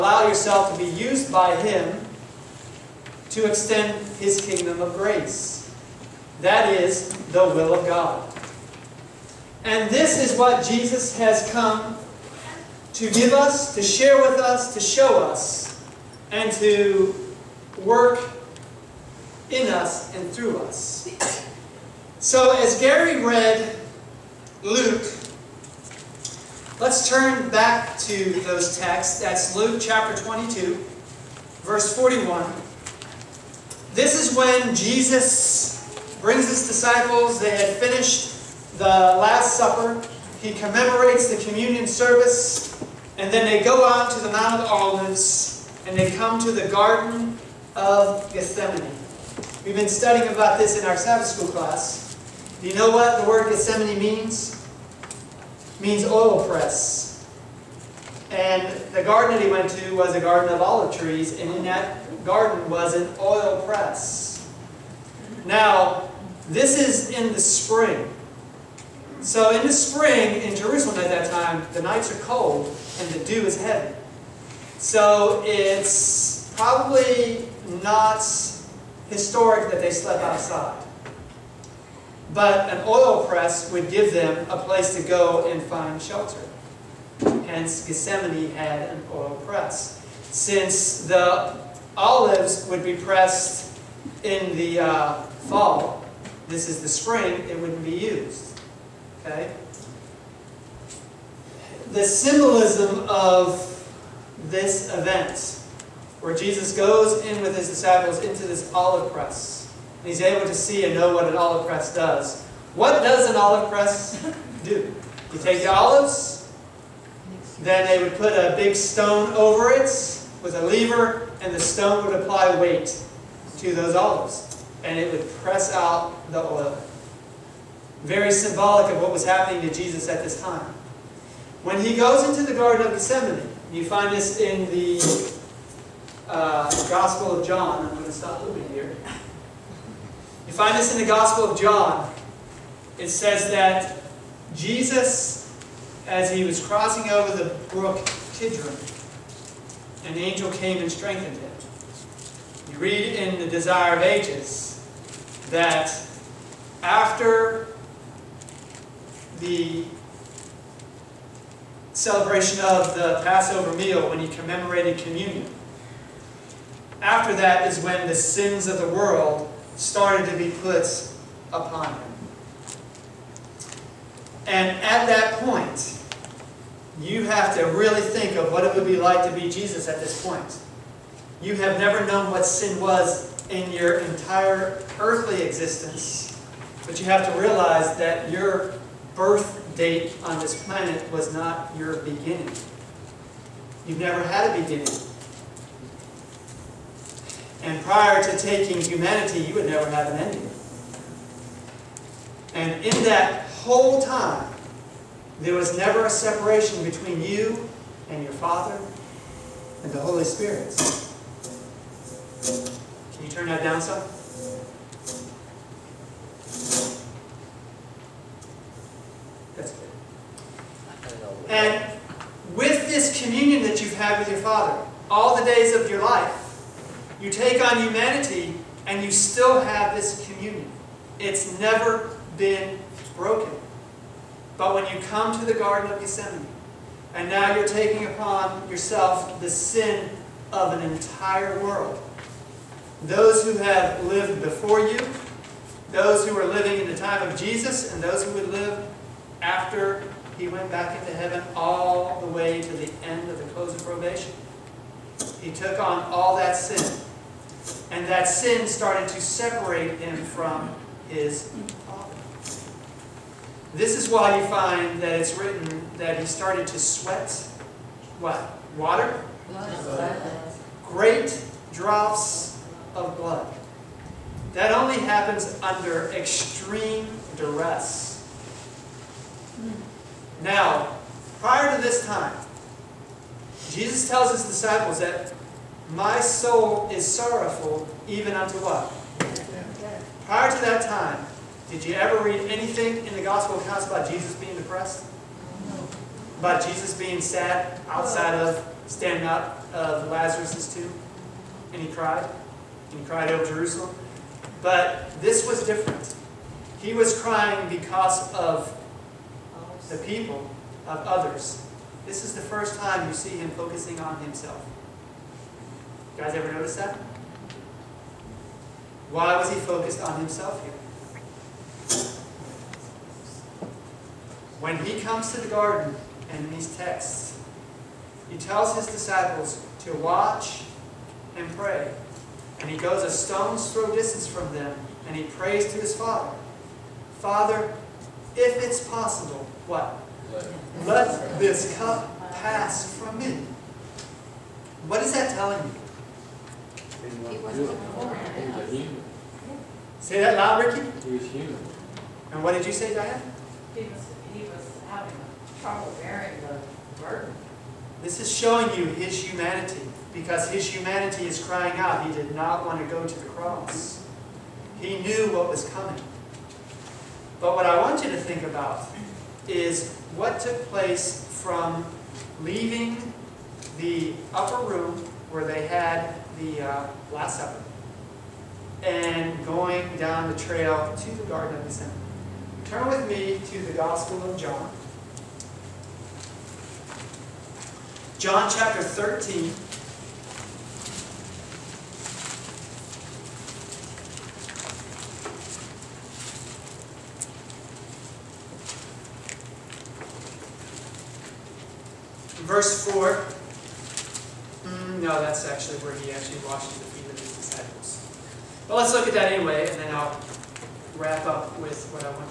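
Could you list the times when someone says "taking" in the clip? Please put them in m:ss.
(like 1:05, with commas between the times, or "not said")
3:18, 3:57.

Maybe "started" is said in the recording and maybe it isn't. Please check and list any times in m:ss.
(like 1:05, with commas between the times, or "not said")
2:49, 4:18, 4:26.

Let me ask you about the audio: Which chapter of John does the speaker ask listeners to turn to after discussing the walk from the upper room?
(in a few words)
13.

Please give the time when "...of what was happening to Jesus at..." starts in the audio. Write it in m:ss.
2:08.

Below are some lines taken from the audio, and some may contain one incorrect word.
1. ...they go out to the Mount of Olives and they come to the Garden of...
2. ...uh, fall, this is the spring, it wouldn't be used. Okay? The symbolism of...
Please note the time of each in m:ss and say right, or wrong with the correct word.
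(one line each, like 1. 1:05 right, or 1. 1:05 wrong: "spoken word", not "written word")
1. 0:43 right
2. 1:34 right.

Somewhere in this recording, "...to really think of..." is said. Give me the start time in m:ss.
2:57.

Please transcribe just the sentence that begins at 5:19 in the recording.
Why was he focused on himself here?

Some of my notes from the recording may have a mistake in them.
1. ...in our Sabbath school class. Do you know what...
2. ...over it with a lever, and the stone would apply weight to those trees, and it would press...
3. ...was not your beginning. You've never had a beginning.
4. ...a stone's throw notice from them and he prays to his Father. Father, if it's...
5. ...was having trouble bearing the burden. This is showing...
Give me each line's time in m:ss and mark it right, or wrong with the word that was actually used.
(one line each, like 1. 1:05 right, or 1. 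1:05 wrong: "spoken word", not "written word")
1. 0:50 right
2. 1:59 wrong: "olives", not "trees"
3. 3:11 right
4. 5:33 wrong: "distance", not "notice"
5. 5:54 right.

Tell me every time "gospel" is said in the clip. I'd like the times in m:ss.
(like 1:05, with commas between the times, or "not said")
2:16, 2:21, 4:53, 6:23.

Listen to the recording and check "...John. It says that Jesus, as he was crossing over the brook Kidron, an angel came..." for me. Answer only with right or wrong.
right.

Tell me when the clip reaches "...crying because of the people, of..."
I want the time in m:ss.
5:07.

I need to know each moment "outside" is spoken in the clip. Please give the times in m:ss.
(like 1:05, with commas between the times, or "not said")
1:20, 4:57.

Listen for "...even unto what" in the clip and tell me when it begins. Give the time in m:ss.
4:48.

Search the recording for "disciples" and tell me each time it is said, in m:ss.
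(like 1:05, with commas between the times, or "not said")
0:36, 1:47, 4:44, 5:28.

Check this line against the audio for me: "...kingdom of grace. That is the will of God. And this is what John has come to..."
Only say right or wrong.
wrong.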